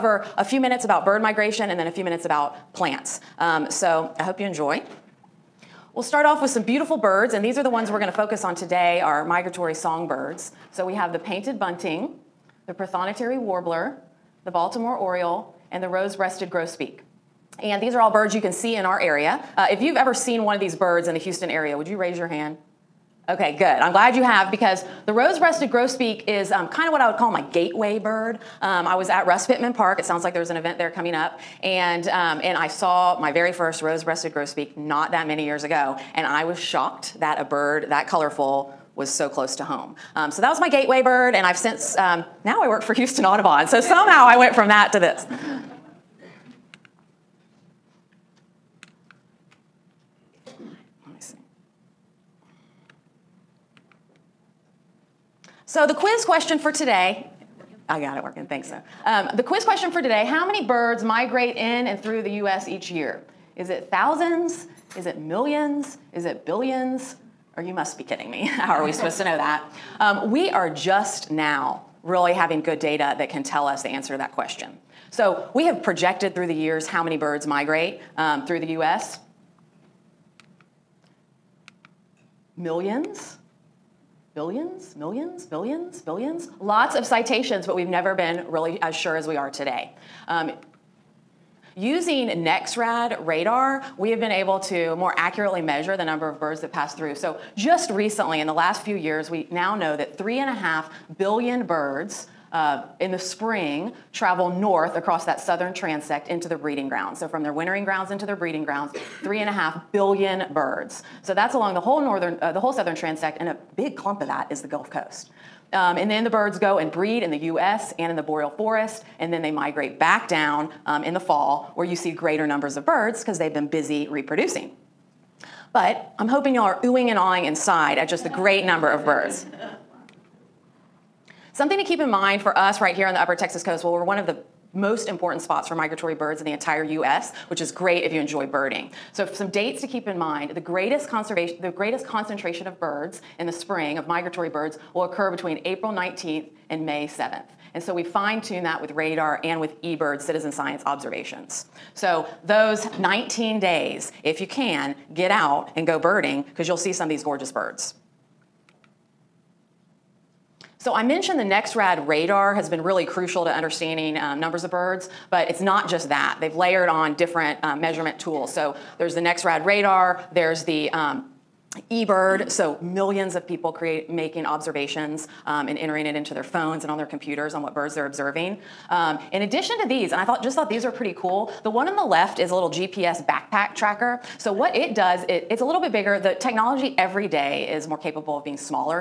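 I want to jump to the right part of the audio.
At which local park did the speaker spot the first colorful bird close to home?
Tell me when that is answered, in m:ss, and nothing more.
0:29.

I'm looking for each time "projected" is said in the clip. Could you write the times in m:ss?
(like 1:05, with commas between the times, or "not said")
1:15.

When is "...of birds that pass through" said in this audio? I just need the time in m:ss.
1:36.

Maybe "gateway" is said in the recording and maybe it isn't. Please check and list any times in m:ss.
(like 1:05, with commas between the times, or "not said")
0:27, 0:40.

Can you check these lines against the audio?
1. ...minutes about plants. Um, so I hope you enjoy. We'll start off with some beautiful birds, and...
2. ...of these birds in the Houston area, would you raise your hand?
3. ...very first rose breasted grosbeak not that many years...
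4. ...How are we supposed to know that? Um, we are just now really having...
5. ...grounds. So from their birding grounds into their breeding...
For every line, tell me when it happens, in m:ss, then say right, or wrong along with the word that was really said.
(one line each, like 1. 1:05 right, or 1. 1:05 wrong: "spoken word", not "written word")
1. 0:02 right
2. 0:20 right
3. 0:33 right
4. 1:08 right
5. 1:46 wrong: "wintering", not "birding".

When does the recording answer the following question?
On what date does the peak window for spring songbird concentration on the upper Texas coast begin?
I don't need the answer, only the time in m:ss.
2:25.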